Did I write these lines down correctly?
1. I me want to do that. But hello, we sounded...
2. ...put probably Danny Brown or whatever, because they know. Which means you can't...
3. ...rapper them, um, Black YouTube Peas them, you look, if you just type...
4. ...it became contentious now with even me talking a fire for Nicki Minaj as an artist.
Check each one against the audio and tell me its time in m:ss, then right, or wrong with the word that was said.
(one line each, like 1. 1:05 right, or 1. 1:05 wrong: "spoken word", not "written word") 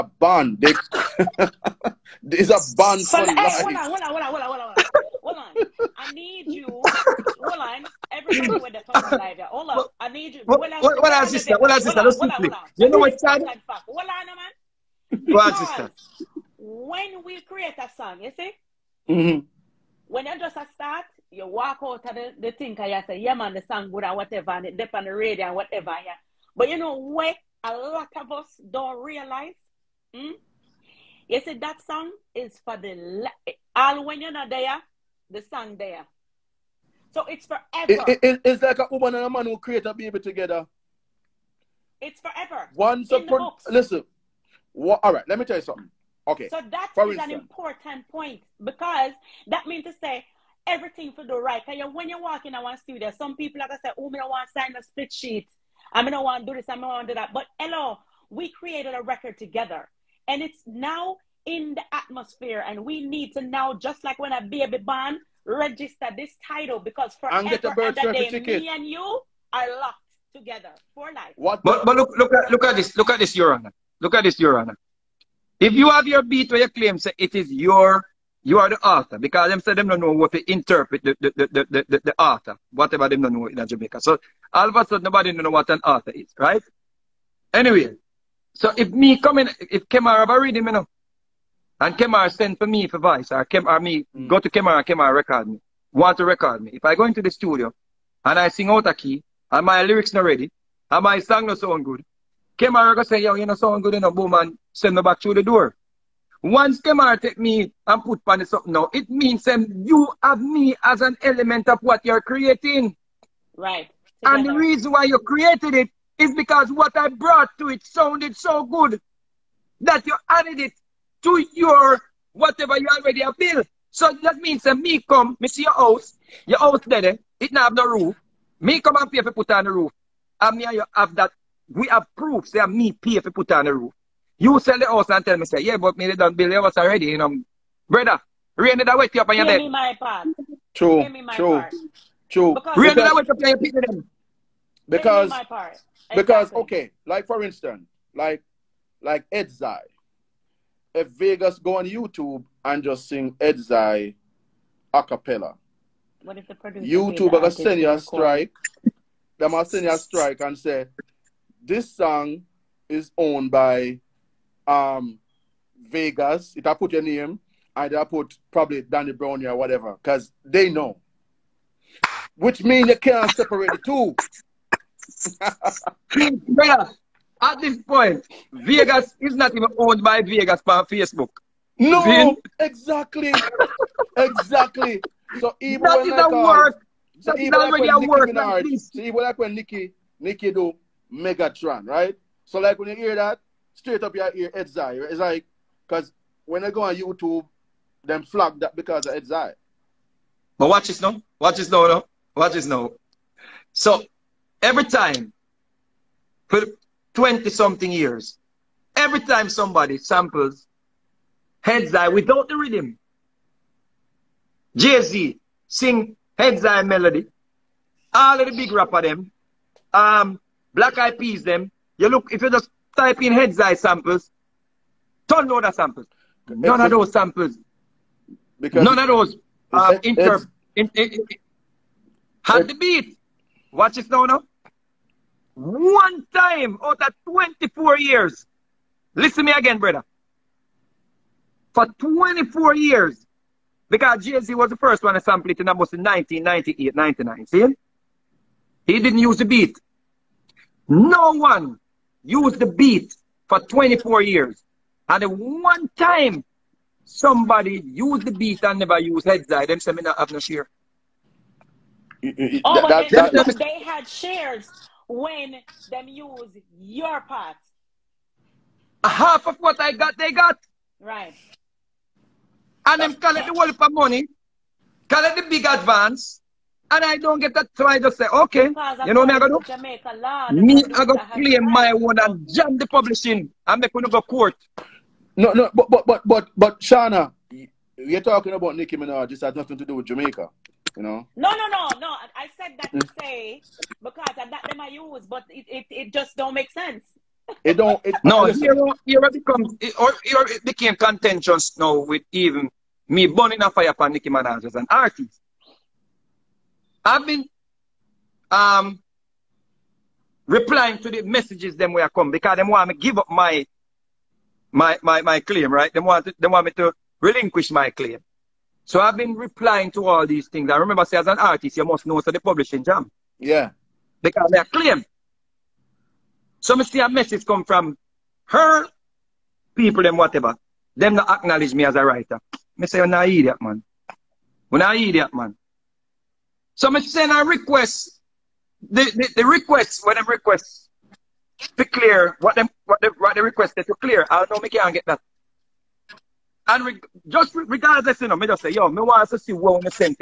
1. 0:56 wrong: "created", not "sounded"
2. 2:48 right
3. 3:38 wrong: "Eyed", not "YouTube"
4. 5:00 wrong: "burning", not "talking".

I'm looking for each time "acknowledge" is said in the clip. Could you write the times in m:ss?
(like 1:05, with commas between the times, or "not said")
5:31.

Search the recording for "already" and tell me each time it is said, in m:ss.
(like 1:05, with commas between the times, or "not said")
1:30, 2:02, 2:16.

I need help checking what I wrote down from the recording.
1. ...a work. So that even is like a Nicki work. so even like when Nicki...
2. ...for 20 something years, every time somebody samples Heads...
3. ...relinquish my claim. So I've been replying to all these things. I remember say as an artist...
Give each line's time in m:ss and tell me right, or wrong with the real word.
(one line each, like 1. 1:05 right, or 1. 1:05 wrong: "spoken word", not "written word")
1. 3:06 right
2. 3:26 right
3. 5:17 right.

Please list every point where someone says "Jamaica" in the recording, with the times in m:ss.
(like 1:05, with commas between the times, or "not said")
1:23, 4:50.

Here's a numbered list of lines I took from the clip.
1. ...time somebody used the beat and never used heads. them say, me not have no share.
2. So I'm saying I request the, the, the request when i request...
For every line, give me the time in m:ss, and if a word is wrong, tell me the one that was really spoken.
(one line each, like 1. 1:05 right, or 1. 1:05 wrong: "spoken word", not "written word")
1. 4:15 right
2. 5:36 right.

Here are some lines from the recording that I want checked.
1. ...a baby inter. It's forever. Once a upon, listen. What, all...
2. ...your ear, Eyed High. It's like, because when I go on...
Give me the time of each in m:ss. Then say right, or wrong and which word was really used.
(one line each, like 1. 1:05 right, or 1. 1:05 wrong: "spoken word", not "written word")
1. 0:39 wrong: "together", not "inter"
2. 3:14 wrong: "Heads", not "Eyed".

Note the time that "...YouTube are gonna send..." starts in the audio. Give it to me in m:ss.
2:36.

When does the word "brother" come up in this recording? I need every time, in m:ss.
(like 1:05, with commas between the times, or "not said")
2:17, 2:56, 3:59.